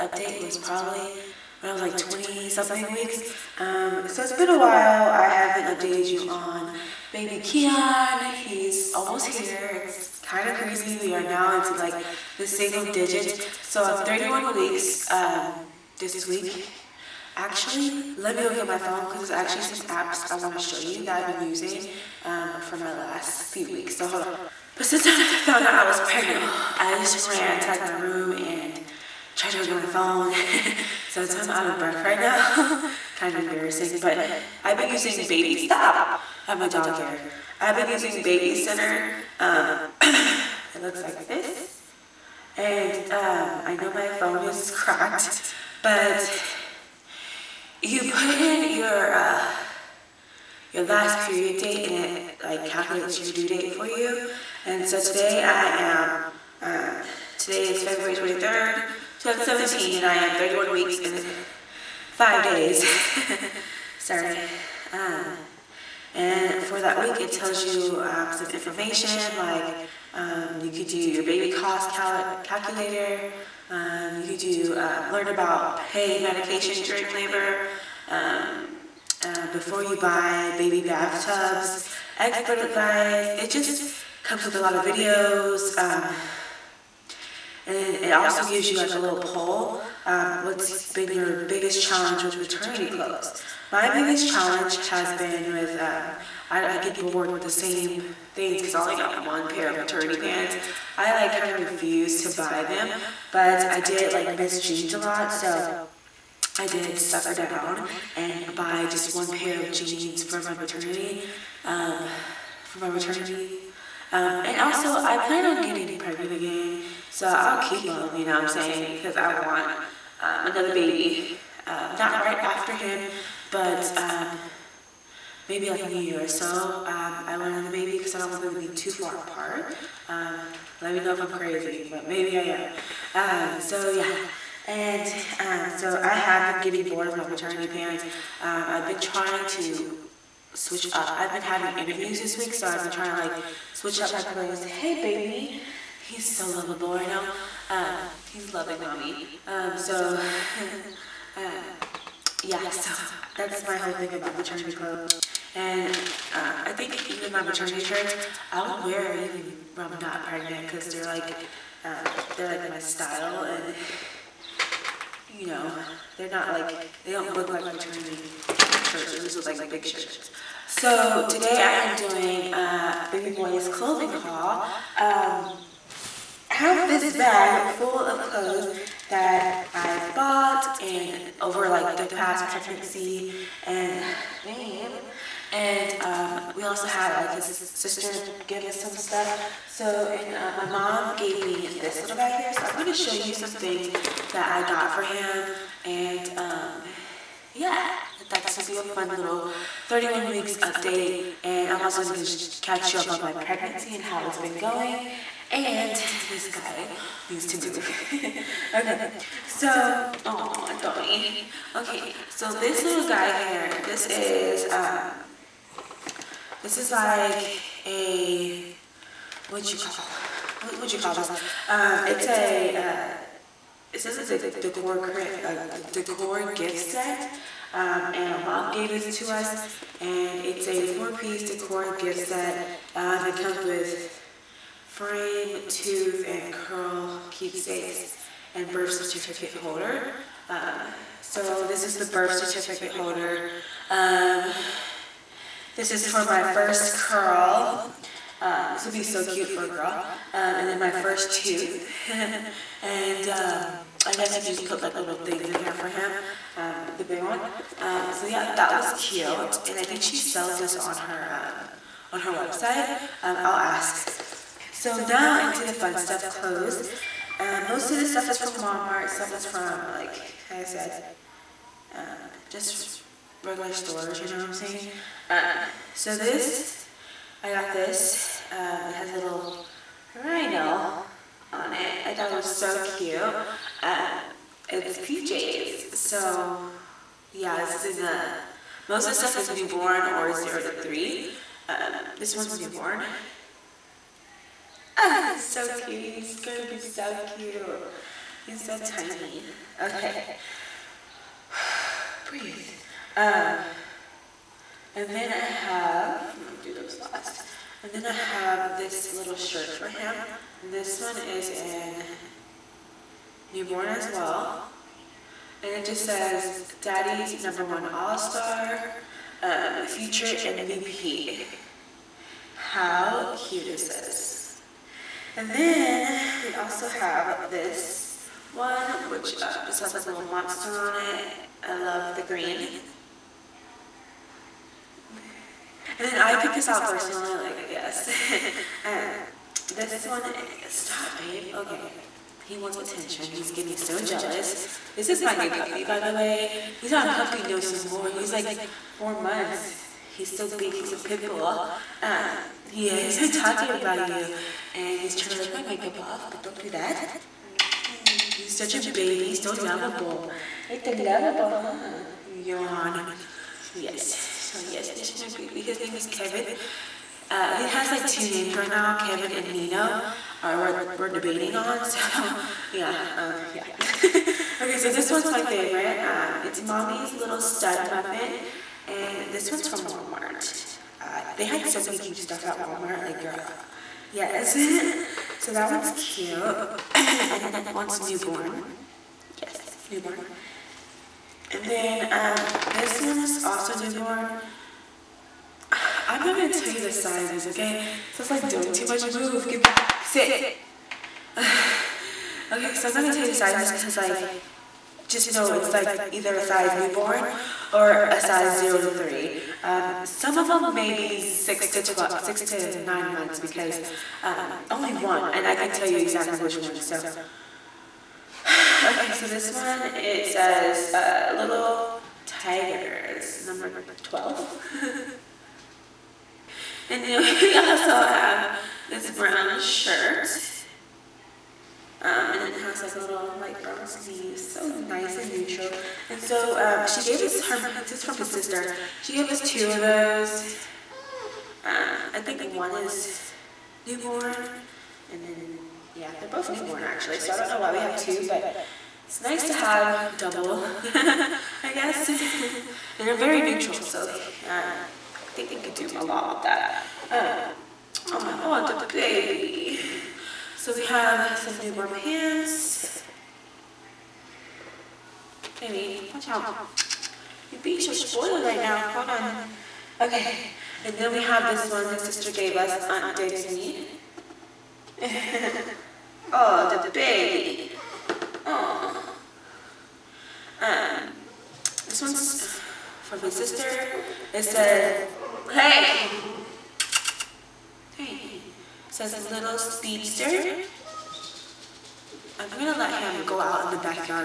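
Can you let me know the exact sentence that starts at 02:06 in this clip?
Um, I want another baby because I don't want them to be too far apart.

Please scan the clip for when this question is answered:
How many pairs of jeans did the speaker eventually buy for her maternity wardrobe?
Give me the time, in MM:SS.
01:48.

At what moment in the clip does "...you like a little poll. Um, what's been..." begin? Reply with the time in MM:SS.
01:28.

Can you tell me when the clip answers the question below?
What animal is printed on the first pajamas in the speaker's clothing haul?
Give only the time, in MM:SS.
04:40.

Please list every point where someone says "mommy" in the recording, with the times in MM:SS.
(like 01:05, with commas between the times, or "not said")
02:28, 06:16.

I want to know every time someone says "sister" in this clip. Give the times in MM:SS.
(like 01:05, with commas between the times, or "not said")
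03:07, 07:18, 07:52, 08:03.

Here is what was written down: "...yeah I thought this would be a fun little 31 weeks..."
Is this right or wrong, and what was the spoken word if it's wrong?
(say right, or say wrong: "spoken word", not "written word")
right.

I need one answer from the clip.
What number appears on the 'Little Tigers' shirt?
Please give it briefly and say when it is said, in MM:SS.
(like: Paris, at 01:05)
12, at 07:03.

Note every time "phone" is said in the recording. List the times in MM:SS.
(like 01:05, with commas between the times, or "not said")
00:18, 00:29, 00:44.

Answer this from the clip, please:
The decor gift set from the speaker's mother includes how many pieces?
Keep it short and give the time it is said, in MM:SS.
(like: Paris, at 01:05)
4, at 03:50.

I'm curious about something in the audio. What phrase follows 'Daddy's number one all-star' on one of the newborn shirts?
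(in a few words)
Future MVP.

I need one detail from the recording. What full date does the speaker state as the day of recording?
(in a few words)
February 23rd, 2017.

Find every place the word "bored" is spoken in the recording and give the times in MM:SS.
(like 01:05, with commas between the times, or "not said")
01:36, 02:16.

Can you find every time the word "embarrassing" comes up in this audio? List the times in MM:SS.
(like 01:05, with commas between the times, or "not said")
00:33.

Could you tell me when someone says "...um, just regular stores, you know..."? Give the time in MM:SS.
04:31.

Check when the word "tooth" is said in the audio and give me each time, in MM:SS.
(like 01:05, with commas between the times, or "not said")
03:55, 04:11.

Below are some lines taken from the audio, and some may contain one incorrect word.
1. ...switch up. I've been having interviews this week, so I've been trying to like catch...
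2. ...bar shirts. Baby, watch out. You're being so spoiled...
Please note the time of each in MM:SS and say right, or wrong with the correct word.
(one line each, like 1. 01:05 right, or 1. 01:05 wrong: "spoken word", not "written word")
1. 02:20 wrong: "switch", not "catch"
2. 07:41 wrong: "pants", not "shirts".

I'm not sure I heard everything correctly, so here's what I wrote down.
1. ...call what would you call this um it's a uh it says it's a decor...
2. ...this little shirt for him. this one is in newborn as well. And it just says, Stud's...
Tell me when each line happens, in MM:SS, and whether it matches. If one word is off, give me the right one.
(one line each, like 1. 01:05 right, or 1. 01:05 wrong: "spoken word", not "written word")
1. 03:39 right
2. 05:08 wrong: "Daddy", not "Stud".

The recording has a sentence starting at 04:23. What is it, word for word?
I'll ask so now into the fun stuff, clothes.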